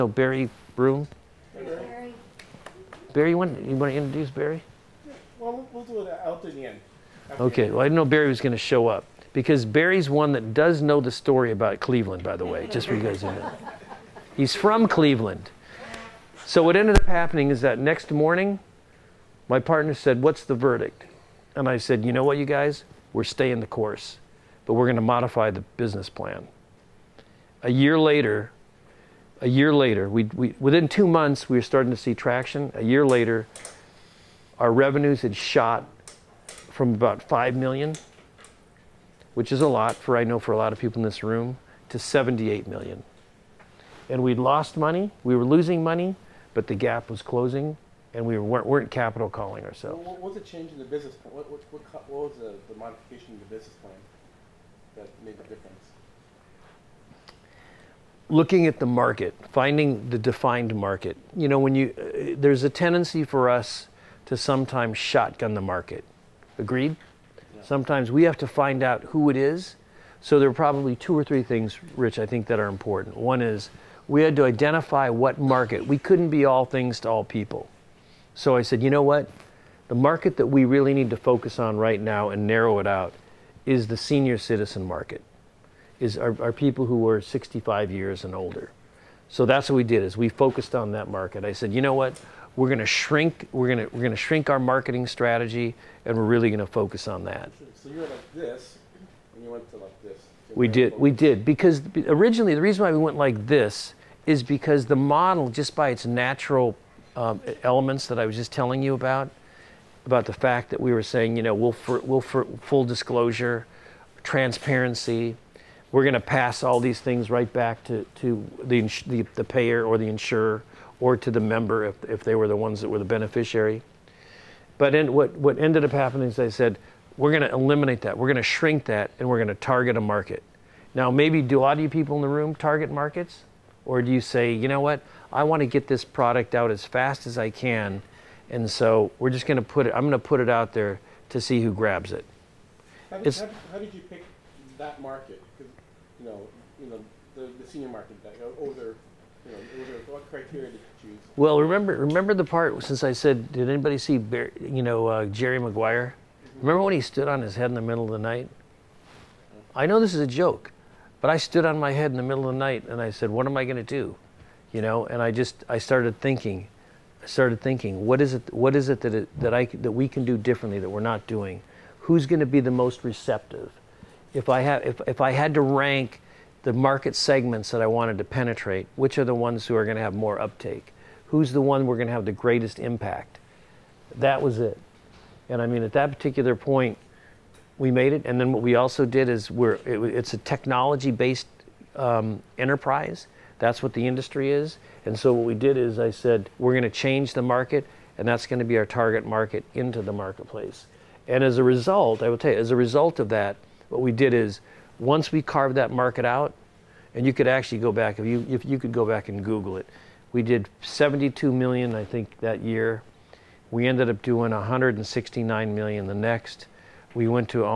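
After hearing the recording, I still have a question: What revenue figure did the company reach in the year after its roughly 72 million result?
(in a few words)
169 million.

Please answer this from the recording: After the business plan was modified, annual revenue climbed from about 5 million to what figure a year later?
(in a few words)
78 million.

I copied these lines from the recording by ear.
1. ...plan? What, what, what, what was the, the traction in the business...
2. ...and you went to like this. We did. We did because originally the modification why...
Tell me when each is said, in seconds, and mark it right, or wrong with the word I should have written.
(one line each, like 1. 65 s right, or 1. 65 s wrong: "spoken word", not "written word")
1. 51 s wrong: "modification", not "traction"
2. 99 s wrong: "reason", not "modification".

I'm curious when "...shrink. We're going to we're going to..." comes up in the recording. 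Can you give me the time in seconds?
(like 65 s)
92 s.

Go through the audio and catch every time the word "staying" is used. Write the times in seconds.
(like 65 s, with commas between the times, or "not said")
23 s.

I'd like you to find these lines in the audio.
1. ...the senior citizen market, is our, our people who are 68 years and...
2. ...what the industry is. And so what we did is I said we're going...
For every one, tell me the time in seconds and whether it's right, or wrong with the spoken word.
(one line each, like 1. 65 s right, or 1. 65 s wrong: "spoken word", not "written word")
1. 83 s wrong: "65", not "68"
2. 193 s right.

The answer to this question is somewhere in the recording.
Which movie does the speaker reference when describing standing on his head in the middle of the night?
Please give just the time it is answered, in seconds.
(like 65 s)
155 s.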